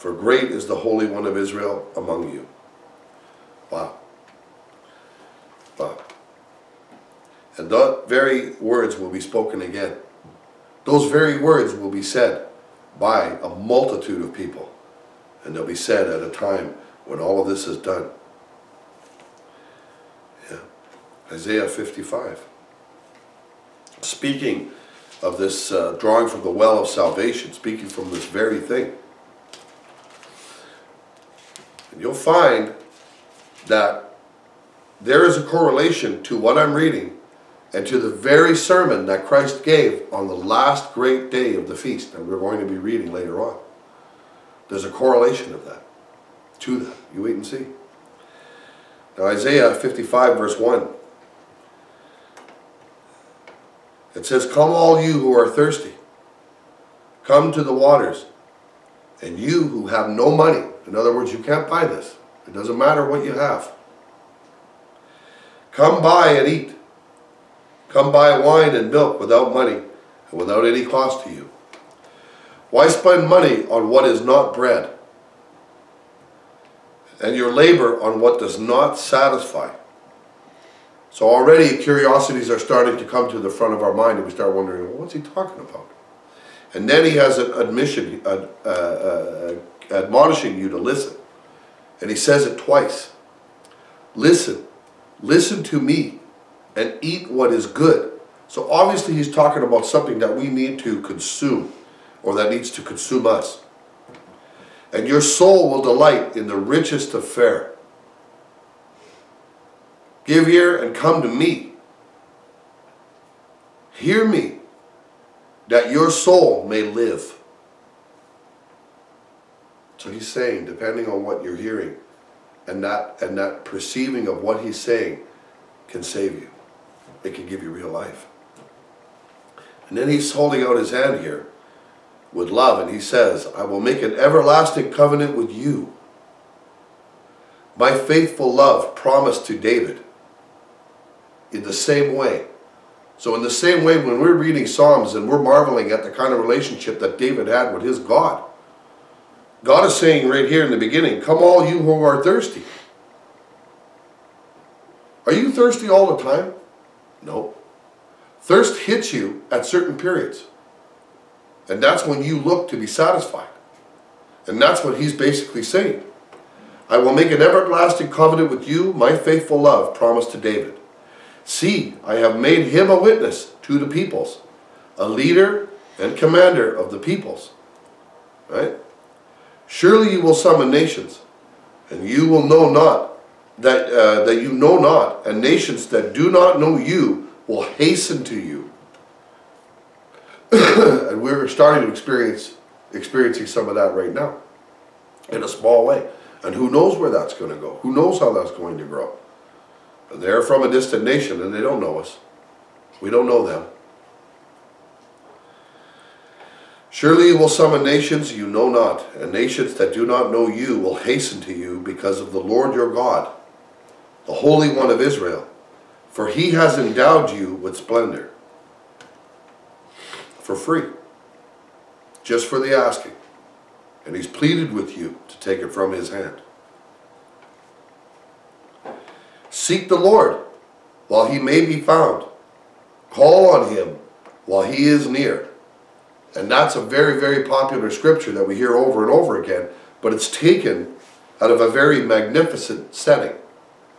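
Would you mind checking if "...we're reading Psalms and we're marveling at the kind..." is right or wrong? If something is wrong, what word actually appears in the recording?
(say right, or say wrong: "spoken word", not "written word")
right.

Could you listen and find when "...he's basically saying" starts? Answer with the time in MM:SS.
02:44.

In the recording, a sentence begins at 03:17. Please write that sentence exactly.
Who knows how that's going to grow?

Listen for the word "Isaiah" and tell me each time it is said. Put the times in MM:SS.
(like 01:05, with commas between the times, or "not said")
00:21, 00:49.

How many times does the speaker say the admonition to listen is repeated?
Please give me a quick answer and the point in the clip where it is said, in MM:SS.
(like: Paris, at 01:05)
twice, at 01:32.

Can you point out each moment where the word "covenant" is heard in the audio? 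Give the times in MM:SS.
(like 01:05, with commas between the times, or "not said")
02:14, 02:48.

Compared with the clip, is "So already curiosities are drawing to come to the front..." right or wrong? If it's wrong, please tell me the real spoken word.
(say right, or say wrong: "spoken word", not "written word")
wrong: "starting", not "drawing".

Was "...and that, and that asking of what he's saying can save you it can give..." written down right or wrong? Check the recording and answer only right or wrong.
wrong.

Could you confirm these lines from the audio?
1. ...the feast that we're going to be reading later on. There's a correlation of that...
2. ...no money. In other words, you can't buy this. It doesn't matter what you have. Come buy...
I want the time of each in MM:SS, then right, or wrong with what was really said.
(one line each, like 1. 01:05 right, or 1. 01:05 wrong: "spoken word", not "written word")
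1. 00:41 right
2. 01:00 right.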